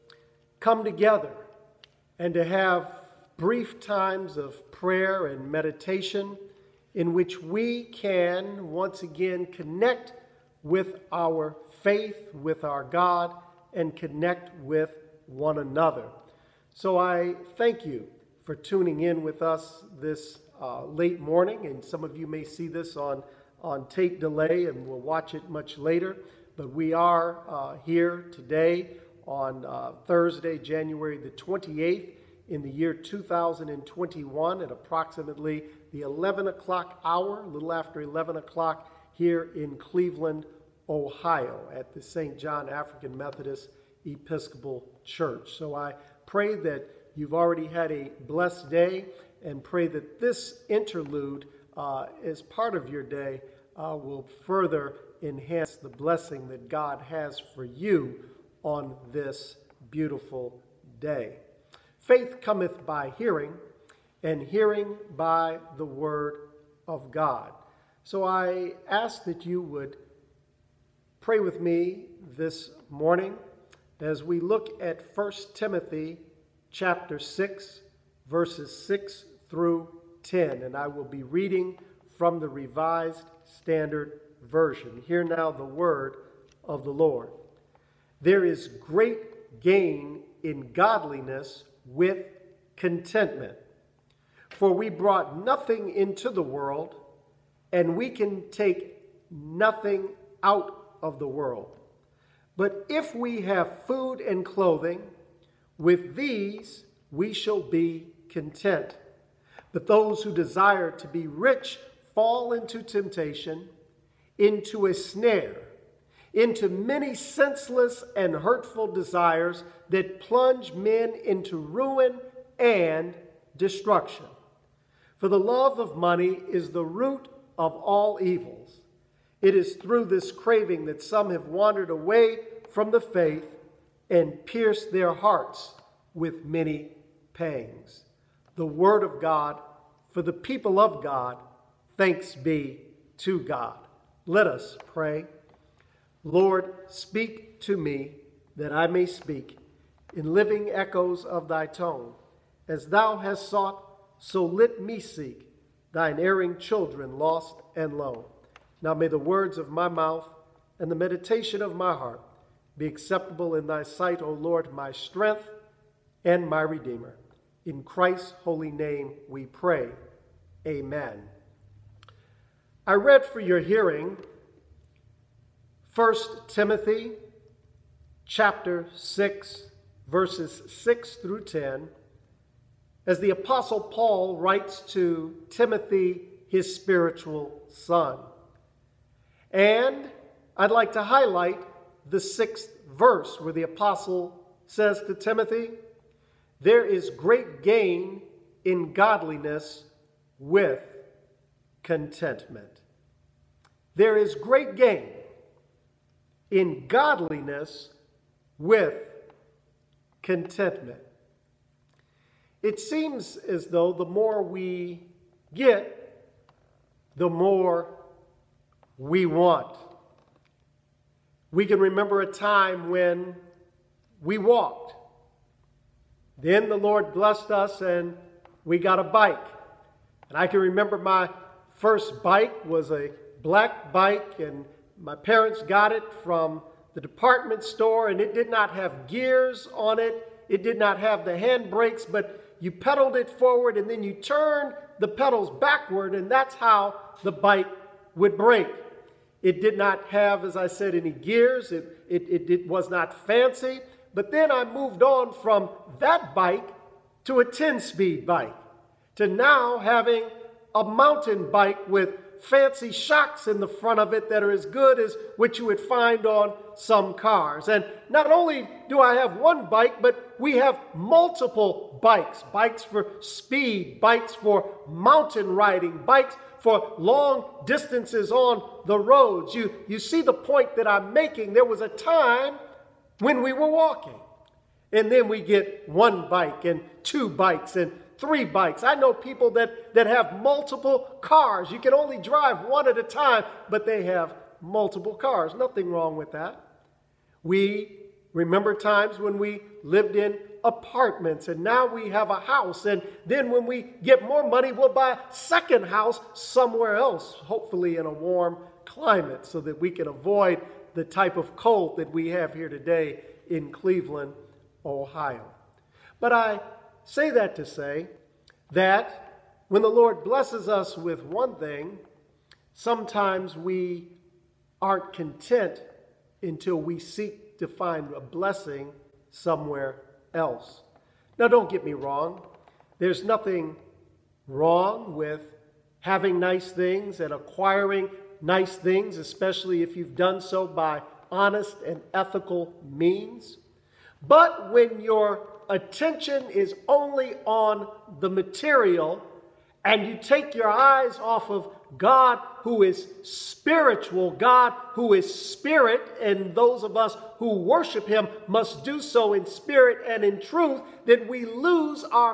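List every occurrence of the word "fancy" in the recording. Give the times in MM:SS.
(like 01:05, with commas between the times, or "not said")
04:13, 04:22.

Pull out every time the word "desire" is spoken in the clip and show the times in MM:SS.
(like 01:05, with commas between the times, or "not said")
01:50, 01:58.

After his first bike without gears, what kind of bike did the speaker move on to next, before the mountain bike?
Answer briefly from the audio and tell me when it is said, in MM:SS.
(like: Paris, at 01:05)
10 speed bike, at 04:17.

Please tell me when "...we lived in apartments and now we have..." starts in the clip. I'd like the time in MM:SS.
04:59.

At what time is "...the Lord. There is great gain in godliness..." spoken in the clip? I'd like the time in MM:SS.
01:26.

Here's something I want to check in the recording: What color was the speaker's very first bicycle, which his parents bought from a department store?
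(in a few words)
Black.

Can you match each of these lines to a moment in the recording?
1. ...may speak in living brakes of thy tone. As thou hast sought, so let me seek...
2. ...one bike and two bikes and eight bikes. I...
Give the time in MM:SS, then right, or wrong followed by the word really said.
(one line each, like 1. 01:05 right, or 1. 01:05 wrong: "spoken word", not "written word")
1. 02:28 wrong: "echoes", not "brakes"
2. 04:45 wrong: "three", not "eight".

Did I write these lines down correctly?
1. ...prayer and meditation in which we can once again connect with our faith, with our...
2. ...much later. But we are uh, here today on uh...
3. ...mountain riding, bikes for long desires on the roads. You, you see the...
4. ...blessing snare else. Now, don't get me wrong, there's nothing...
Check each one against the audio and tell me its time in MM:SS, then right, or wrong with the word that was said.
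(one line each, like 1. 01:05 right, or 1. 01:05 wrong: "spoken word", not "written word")
1. 00:04 right
2. 00:25 right
3. 04:34 wrong: "distances", not "desires"
4. 05:28 wrong: "somewhere", not "snare".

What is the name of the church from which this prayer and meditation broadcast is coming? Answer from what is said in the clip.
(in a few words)
St. John African Methodist Episcopal Church.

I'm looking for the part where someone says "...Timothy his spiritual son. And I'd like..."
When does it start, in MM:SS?
03:05.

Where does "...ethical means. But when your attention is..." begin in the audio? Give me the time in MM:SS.
05:42.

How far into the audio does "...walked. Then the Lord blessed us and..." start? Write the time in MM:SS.
03:44.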